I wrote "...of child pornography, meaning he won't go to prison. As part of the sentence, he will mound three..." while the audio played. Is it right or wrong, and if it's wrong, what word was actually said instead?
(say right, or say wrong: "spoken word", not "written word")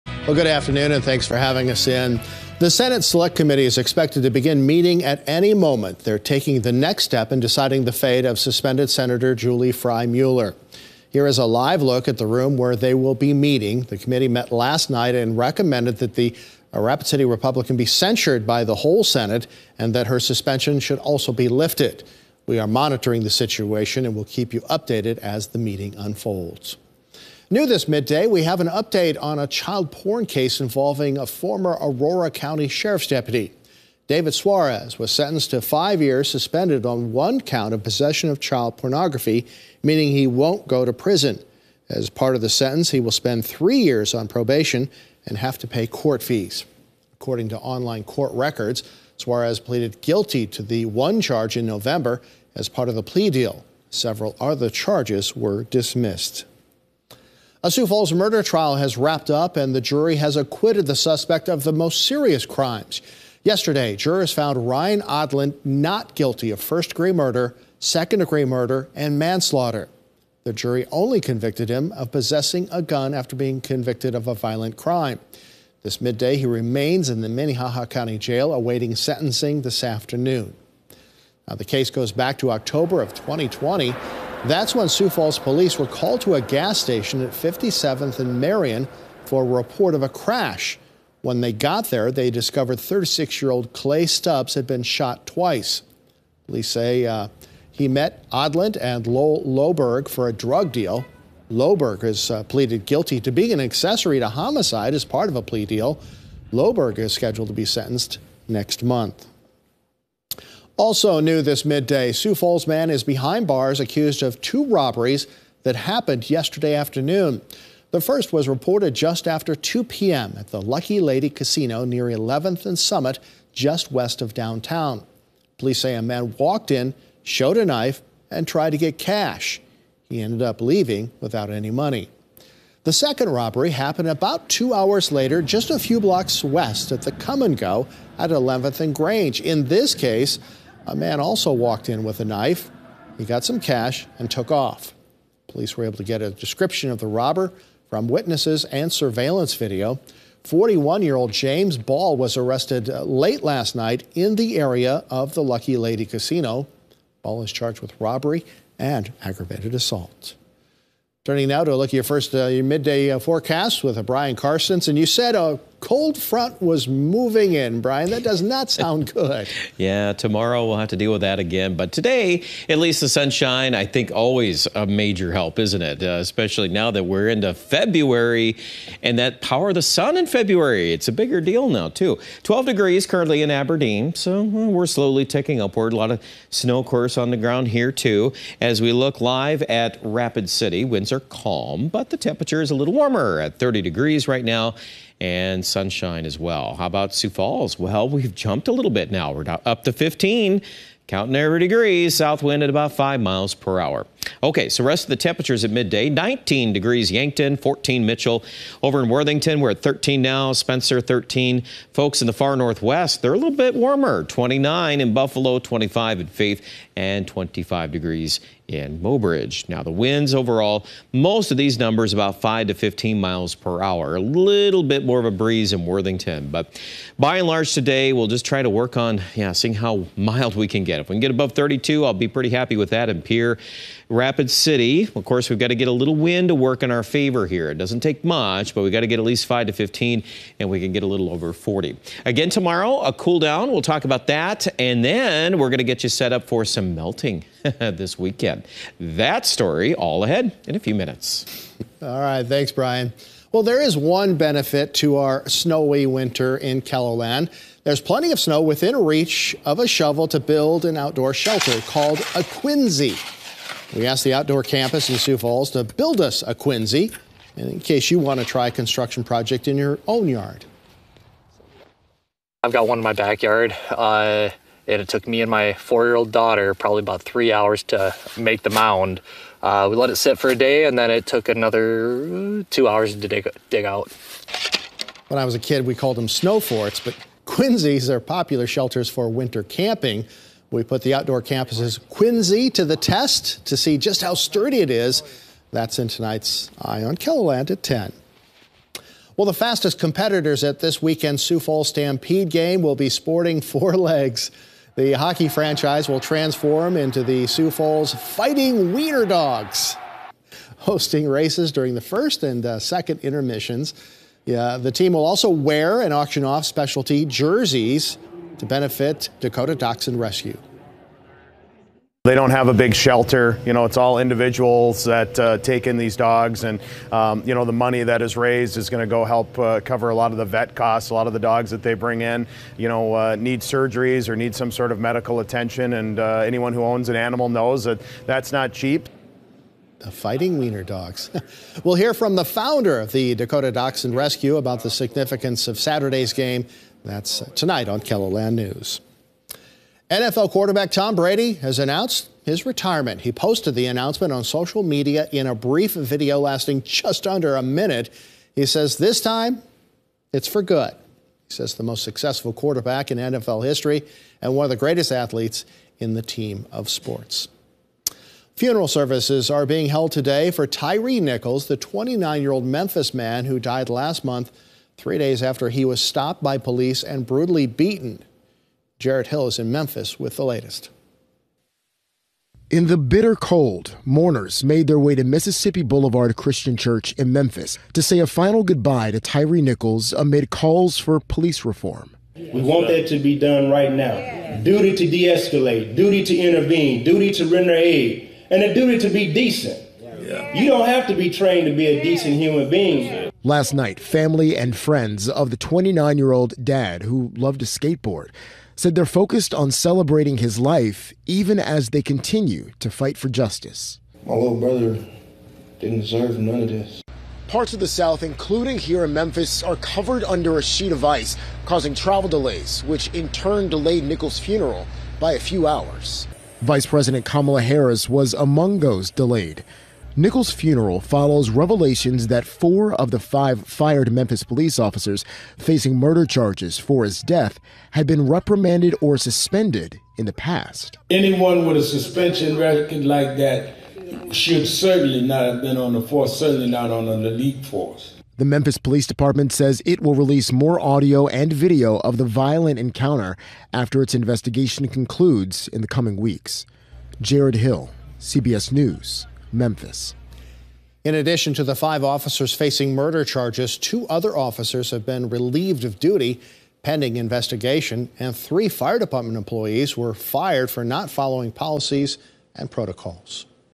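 wrong: "spend", not "mound".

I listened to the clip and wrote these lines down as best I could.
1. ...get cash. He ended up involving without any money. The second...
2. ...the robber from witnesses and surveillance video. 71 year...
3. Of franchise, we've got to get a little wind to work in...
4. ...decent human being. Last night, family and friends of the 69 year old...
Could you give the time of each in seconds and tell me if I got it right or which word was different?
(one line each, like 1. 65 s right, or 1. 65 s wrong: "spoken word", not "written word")
1. 128 s wrong: "leaving", not "involving"
2. 146 s wrong: "41", not "71"
3. 235 s wrong: "course", not "franchise"
4. 402 s wrong: "29", not "69".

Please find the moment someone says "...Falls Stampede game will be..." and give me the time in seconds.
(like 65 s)
301 s.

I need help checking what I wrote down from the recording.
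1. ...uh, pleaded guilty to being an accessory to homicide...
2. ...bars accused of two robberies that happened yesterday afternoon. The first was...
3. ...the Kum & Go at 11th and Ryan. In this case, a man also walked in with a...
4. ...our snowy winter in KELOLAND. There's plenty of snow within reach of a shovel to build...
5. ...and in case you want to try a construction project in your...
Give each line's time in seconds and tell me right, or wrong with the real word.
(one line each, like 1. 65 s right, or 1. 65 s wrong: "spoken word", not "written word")
1. 102 s right
2. 113 s right
3. 137 s wrong: "Grange", not "Ryan"
4. 255 s right
5. 267 s right.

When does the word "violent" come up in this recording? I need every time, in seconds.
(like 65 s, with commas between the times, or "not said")
74 s, 452 s.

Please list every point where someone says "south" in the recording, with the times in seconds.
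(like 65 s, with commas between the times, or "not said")
202 s, 417 s.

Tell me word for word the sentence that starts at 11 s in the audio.
Here is a live look at the room where they will be meeting.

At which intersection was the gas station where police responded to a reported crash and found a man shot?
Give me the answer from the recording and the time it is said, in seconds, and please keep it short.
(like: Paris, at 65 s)
57th and Marion, at 87 s.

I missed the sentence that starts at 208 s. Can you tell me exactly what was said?
Over in Worthington, we're at 13 now, Spencer 13.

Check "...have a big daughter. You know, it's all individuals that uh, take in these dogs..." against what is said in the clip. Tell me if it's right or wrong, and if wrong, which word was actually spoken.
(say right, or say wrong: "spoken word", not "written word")
wrong: "shelter", not "daughter".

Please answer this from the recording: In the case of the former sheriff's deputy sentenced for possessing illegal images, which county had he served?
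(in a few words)
Aurora County.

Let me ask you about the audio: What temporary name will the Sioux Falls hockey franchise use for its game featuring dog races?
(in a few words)
Sioux Falls Fighting Wiener Dogs.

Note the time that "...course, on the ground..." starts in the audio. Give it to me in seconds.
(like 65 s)
186 s.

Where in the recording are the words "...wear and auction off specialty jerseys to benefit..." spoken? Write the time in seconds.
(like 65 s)
315 s.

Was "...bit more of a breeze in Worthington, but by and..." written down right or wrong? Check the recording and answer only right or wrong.
right.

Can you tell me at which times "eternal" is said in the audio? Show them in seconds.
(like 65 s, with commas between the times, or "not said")
not said.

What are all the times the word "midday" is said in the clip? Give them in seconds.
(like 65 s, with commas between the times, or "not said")
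27 s, 76 s, 111 s, 162 s, 205 s.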